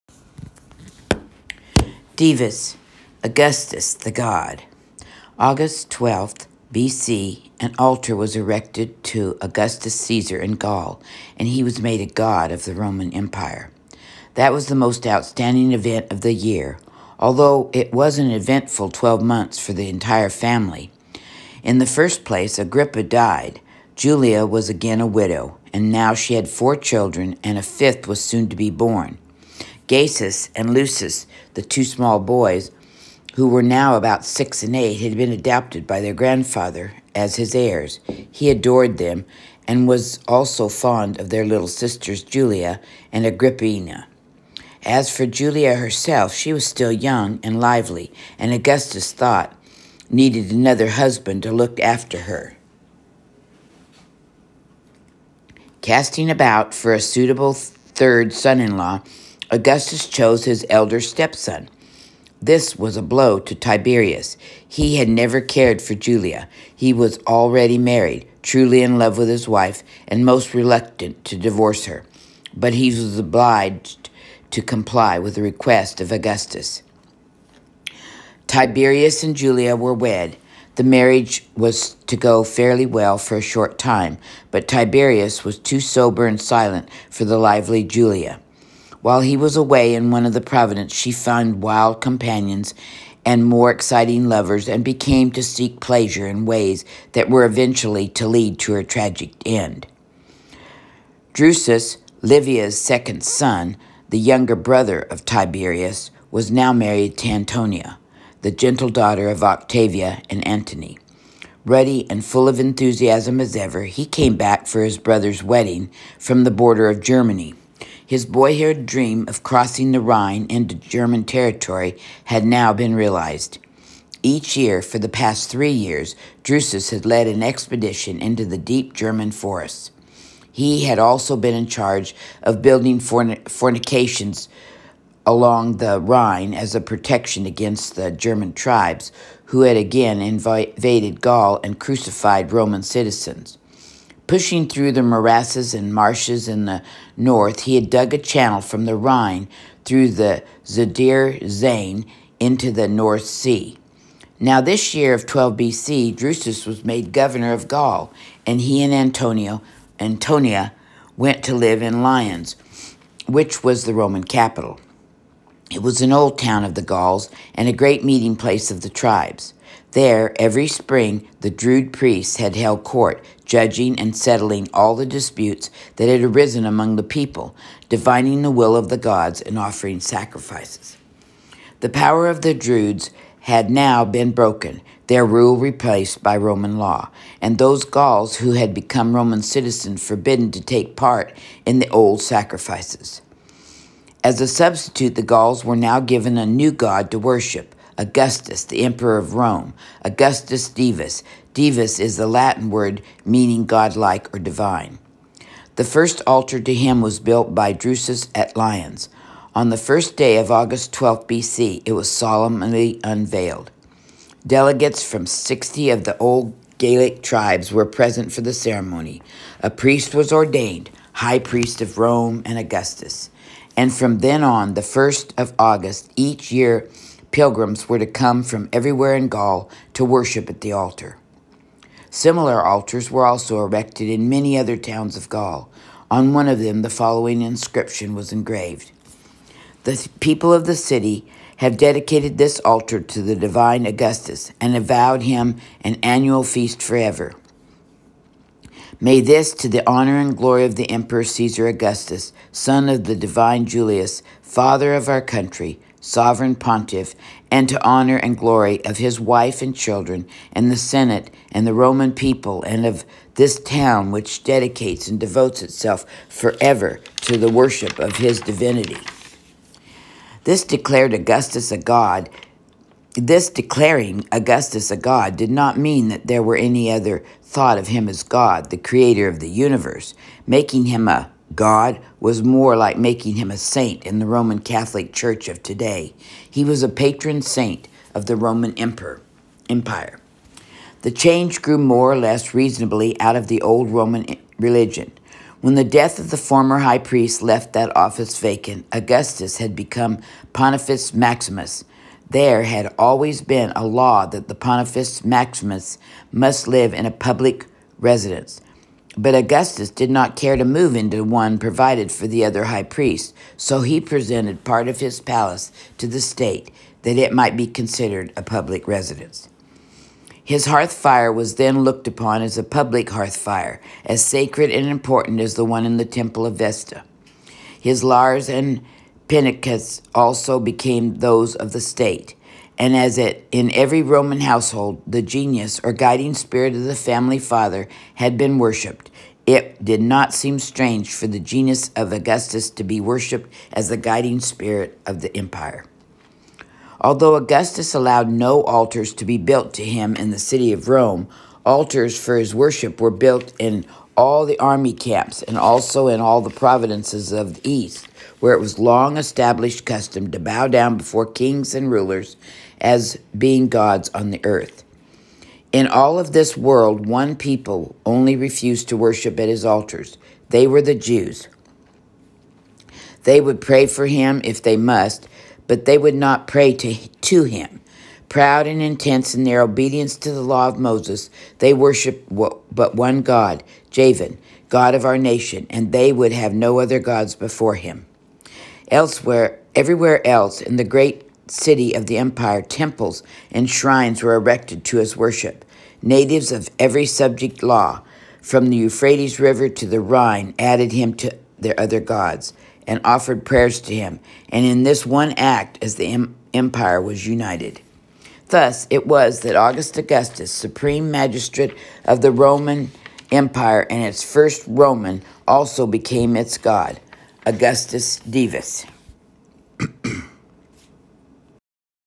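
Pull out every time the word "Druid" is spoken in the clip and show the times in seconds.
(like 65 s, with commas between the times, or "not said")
171 s, 182 s.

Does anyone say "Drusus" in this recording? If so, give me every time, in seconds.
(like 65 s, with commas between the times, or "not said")
101 s, 126 s, 156 s, 207 s.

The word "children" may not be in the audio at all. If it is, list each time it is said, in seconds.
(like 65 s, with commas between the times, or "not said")
26 s, 259 s.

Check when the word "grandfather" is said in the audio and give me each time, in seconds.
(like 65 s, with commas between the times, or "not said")
36 s.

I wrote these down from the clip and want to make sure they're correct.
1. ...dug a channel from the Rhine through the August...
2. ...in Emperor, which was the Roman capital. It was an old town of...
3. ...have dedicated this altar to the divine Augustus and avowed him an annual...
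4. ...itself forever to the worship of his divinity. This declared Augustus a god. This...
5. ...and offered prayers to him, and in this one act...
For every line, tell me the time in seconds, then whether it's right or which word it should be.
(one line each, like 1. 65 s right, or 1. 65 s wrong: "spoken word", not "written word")
1. 147 s wrong: "Zuider", not "August"
2. 161 s wrong: "Lyons", not "Emperor"
3. 241 s right
4. 265 s right
5. 402 s right.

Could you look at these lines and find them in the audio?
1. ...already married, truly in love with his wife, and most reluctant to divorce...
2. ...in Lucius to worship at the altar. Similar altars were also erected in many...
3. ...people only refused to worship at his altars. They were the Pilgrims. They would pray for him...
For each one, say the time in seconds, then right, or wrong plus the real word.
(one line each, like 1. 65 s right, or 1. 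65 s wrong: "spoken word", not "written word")
1. 67 s right
2. 229 s wrong: "Gaul", not "Lucius"
3. 367 s wrong: "Jews", not "Pilgrims".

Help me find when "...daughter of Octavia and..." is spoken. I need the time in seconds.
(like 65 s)
108 s.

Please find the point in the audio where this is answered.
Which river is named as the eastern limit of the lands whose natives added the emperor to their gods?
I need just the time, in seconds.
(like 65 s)
398 s.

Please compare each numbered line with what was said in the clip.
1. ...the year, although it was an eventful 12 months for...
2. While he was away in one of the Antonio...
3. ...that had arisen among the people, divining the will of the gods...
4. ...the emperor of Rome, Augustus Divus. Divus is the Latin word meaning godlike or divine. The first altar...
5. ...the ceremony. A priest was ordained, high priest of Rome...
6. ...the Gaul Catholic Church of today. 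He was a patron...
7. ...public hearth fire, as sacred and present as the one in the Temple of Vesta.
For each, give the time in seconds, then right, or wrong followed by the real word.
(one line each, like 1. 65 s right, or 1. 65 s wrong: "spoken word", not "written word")
1. 16 s right
2. 89 s wrong: "Providence", not "Antonio"
3. 175 s right
4. 198 s right
5. 218 s right
6. 284 s wrong: "Roman", not "Gaul"
7. 322 s wrong: "important", not "present".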